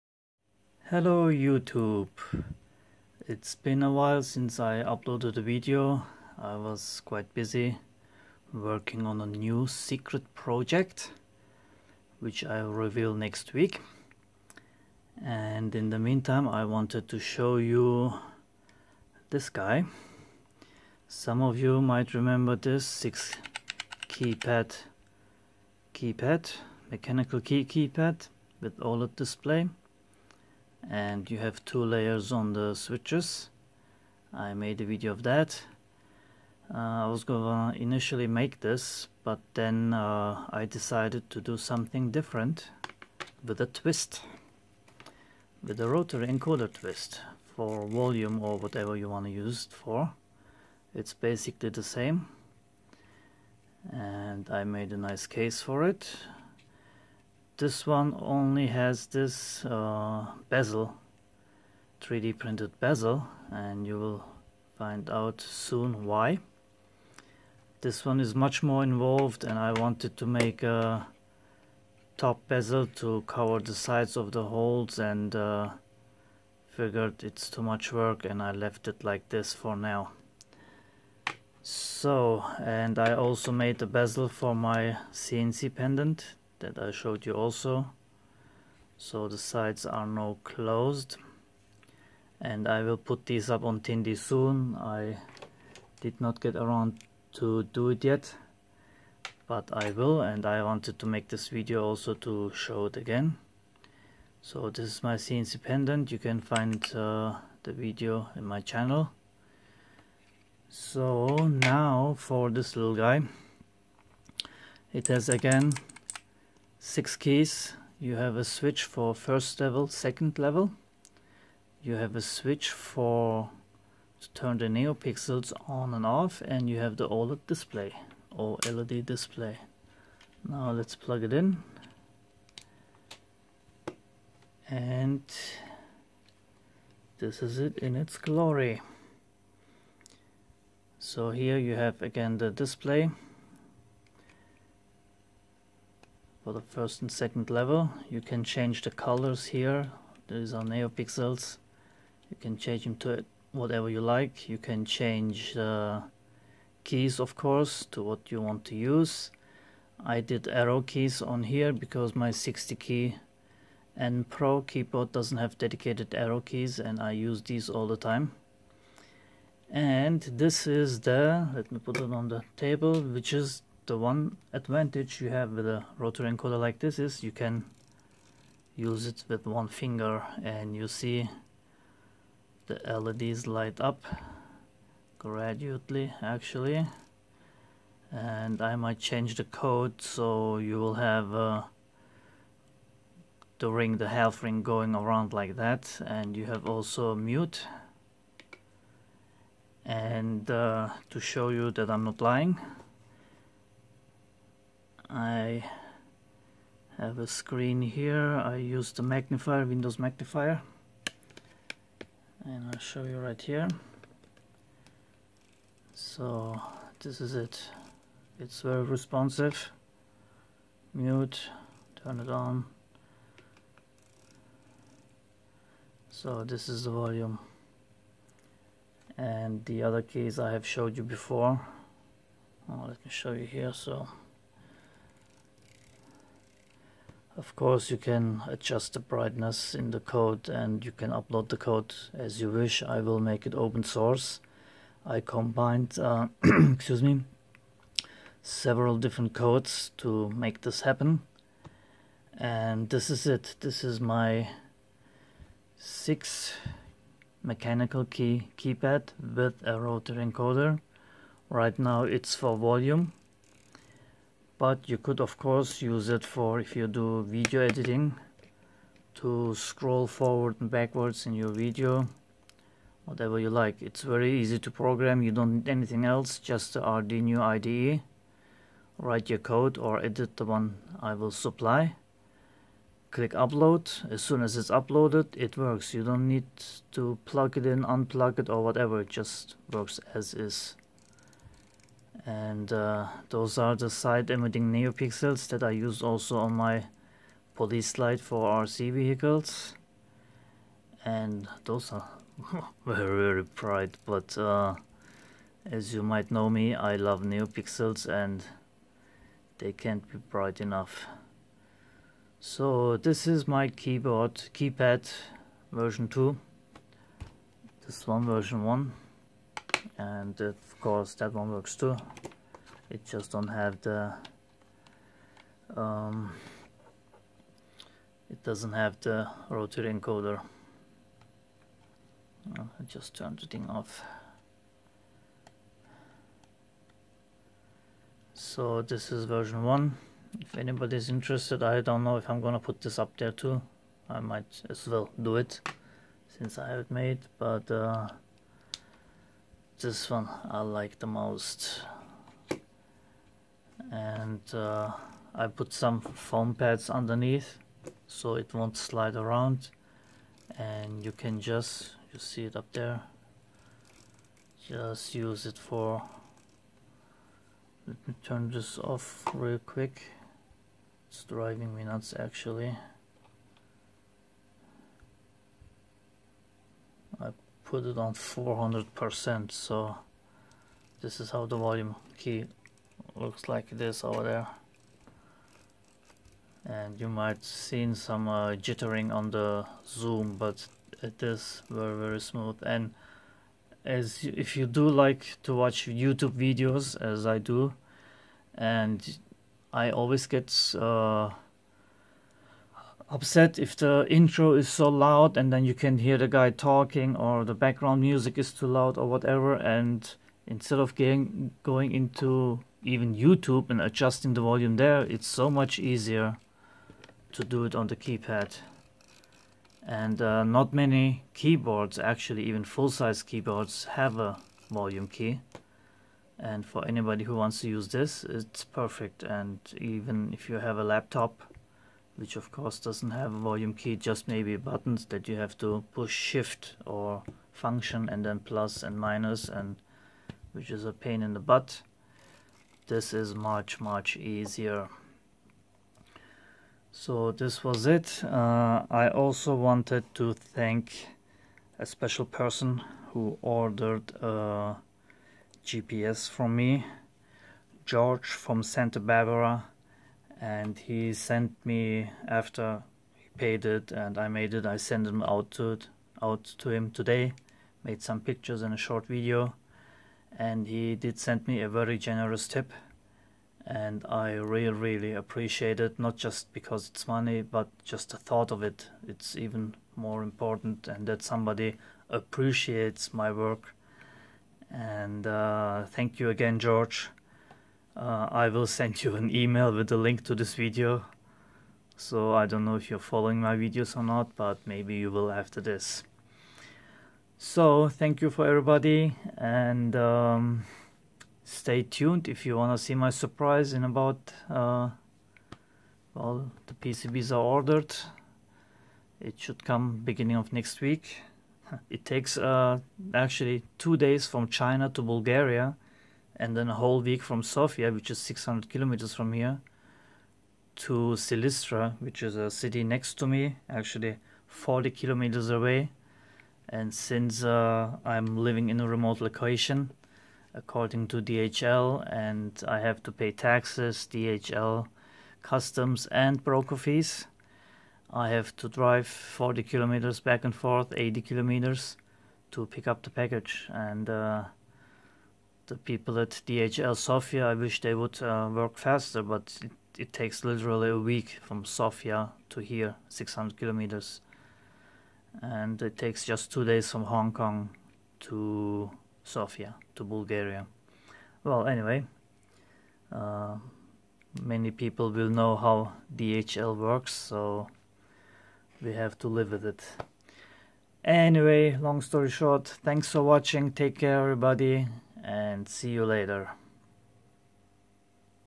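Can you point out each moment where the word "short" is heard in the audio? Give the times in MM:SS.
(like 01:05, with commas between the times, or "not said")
07:48, 09:32.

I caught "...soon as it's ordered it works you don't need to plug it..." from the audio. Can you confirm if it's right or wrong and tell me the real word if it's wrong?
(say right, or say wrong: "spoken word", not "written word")
wrong: "uploaded", not "ordered".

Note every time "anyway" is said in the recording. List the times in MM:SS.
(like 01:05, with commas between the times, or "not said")
09:21, 09:31.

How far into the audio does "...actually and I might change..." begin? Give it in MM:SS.
03:06.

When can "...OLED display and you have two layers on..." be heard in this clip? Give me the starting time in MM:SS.
00:28.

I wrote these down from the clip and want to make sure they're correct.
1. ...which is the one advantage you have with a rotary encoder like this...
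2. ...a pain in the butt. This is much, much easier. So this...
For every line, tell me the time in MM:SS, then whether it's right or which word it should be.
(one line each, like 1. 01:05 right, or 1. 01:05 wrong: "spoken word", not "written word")
1. 02:53 right
2. 07:20 right.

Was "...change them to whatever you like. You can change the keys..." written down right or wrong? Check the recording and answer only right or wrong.
right.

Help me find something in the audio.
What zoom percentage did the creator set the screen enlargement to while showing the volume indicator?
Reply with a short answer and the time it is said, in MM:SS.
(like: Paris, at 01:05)
400%, at 06:18.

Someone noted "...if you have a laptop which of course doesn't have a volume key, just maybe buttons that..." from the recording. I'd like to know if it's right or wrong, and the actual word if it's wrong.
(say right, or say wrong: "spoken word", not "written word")
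right.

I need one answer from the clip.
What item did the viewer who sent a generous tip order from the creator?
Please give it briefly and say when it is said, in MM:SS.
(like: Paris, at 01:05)
GPS, at 07:35.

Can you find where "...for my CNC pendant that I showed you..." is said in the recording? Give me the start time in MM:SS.
01:24.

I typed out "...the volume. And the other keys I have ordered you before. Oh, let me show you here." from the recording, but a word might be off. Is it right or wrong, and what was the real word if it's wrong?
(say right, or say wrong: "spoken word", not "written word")
wrong: "showed", not "ordered".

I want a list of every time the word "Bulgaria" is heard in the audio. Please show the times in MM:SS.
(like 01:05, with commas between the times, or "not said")
08:35, 09:20.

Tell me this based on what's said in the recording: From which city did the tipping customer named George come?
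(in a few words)
Santa Barbara.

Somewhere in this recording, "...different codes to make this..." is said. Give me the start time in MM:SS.
04:08.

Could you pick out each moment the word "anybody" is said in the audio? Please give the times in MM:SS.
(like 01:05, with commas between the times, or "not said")
05:40, 07:06.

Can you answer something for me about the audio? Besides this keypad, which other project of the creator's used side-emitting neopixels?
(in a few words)
police light for RC vehicles.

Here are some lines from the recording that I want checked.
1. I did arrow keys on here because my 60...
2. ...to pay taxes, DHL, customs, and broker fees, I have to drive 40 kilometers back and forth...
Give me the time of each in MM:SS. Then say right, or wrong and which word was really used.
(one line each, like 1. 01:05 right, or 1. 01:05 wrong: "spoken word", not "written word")
1. 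02:40 right
2. 08:53 right.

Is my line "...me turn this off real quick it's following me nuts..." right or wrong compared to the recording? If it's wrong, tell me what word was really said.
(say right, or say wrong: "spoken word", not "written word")
wrong: "driving", not "following".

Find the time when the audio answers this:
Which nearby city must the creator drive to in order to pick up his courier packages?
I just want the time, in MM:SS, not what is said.
08:41.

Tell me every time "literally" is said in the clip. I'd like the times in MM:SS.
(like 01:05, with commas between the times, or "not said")
09:10.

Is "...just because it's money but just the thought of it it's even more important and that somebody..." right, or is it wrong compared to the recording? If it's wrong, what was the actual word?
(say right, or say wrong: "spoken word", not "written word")
right.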